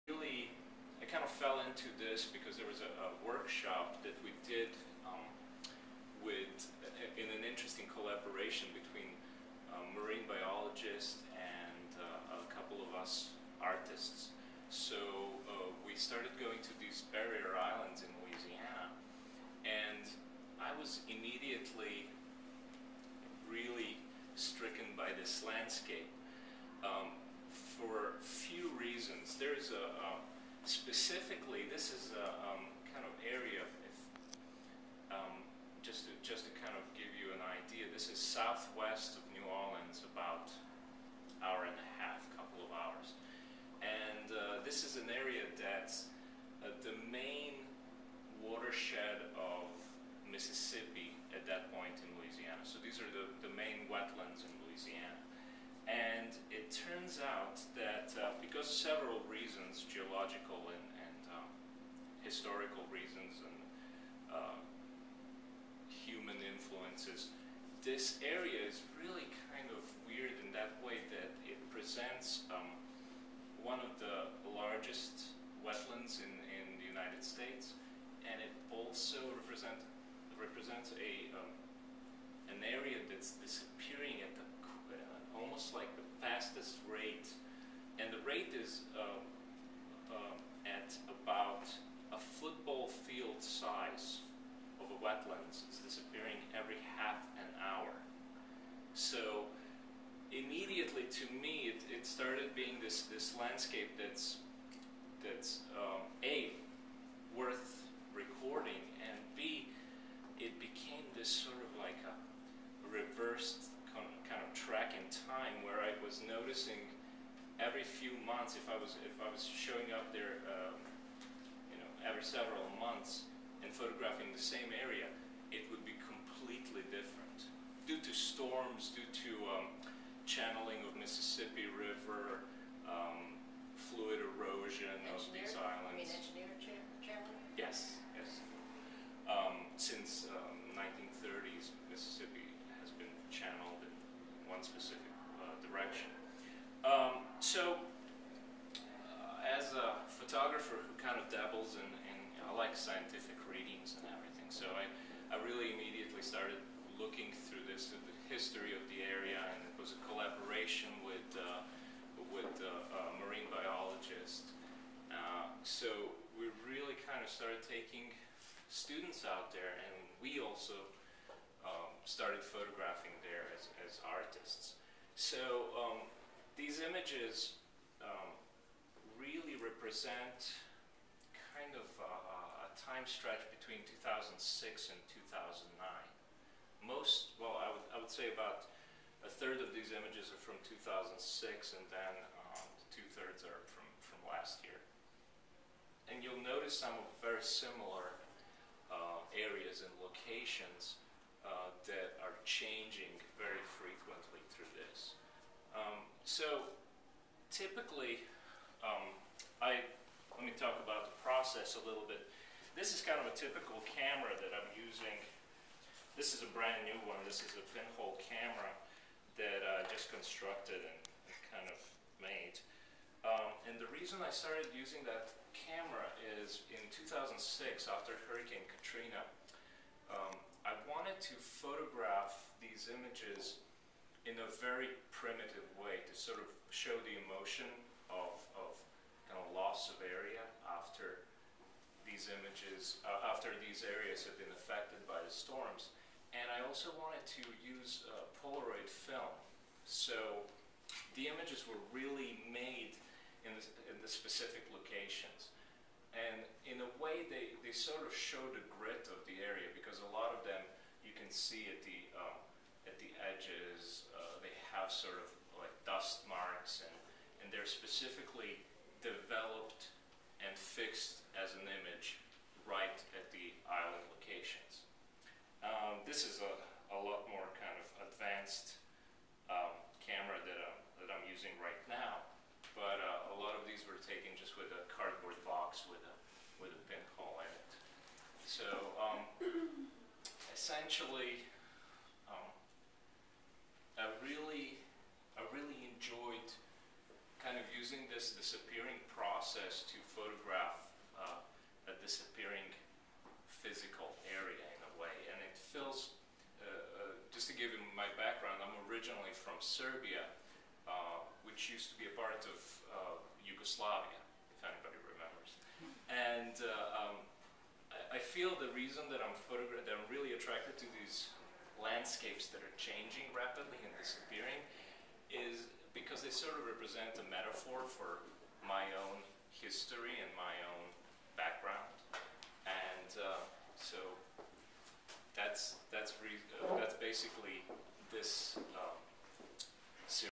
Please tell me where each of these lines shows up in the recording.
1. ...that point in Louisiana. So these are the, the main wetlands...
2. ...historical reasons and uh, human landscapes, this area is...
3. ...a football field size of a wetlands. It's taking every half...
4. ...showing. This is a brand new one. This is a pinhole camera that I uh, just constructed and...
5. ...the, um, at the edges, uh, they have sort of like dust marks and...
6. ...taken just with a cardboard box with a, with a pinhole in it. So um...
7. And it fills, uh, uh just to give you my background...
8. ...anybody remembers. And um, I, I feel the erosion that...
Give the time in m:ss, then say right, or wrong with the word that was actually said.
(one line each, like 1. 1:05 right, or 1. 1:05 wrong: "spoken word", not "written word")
1. 0:51 right
2. 1:02 wrong: "influences", not "landscapes"
3. 1:32 wrong: "disappearing", not "taking"
4. 3:34 wrong: "using", not "showing"
5. 4:21 right
6. 4:44 right
7. 5:05 right
8. 5:14 wrong: "reason", not "erosion".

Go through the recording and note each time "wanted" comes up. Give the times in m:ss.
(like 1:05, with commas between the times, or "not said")
3:50, 4:06.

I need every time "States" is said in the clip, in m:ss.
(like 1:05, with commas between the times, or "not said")
1:17.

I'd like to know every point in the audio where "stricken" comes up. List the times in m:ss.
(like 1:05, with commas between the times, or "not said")
0:24.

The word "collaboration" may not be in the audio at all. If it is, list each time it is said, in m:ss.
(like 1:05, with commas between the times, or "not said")
0:07, 2:40.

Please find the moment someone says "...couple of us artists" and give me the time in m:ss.
0:12.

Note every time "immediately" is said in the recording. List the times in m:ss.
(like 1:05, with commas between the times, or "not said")
0:21, 1:40, 2:35.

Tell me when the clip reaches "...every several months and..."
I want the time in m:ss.
2:02.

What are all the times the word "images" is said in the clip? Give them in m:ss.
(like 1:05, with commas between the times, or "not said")
2:56, 3:09, 3:52, 4:02, 4:11, 4:31.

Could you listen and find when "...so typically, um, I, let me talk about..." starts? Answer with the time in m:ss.
3:26.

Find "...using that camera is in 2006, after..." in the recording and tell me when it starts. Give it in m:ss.
3:44.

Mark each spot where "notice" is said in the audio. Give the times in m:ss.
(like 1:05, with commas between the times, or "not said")
3:16.